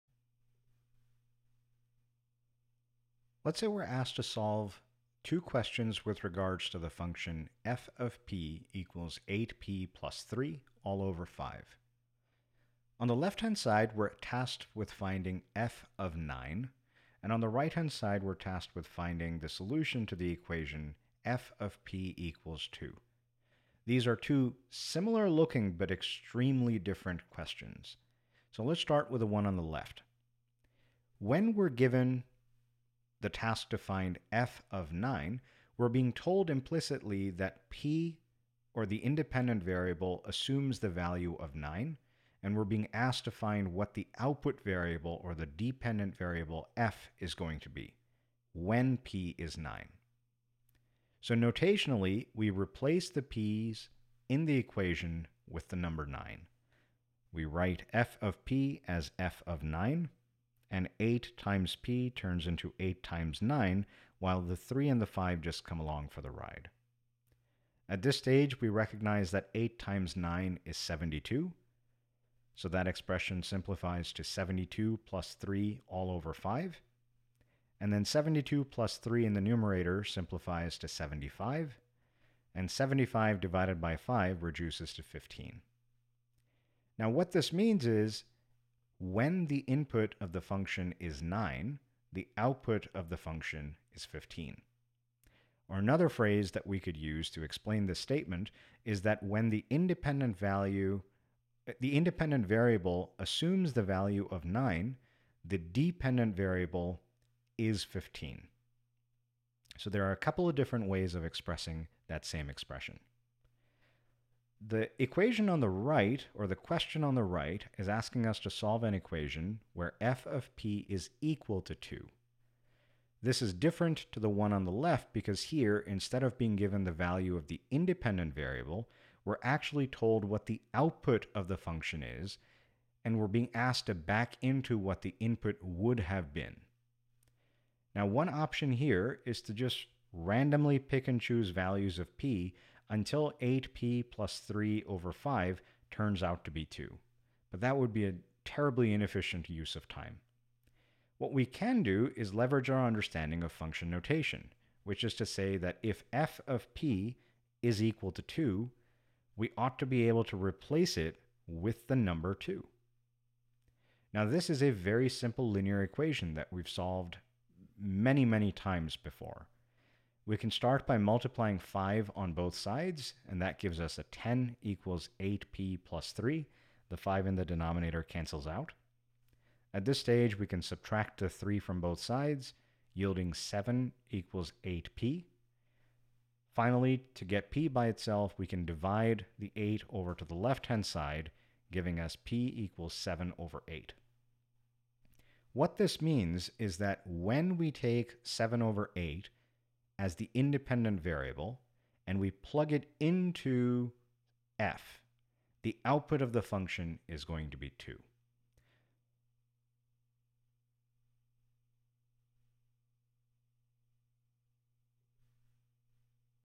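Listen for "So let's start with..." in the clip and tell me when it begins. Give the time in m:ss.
0:28.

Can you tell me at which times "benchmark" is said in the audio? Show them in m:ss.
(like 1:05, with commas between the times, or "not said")
not said.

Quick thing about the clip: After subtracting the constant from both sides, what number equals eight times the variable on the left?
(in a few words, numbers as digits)
7.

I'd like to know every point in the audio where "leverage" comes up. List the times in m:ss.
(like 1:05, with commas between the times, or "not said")
2:32.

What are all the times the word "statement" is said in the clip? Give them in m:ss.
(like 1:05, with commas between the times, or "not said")
1:37.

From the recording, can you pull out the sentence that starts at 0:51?
So notationally, we replace the p's in the equation with the number 9.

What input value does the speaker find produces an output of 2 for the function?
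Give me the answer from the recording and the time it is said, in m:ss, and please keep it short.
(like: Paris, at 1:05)
7/8, at 3:12.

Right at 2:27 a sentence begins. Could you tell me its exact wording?
But that would be a terribly inefficient use of time.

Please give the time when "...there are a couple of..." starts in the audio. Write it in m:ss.
1:49.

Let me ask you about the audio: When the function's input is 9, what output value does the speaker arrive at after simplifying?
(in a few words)
15.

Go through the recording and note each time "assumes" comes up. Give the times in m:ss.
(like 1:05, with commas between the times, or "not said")
0:40, 1:43.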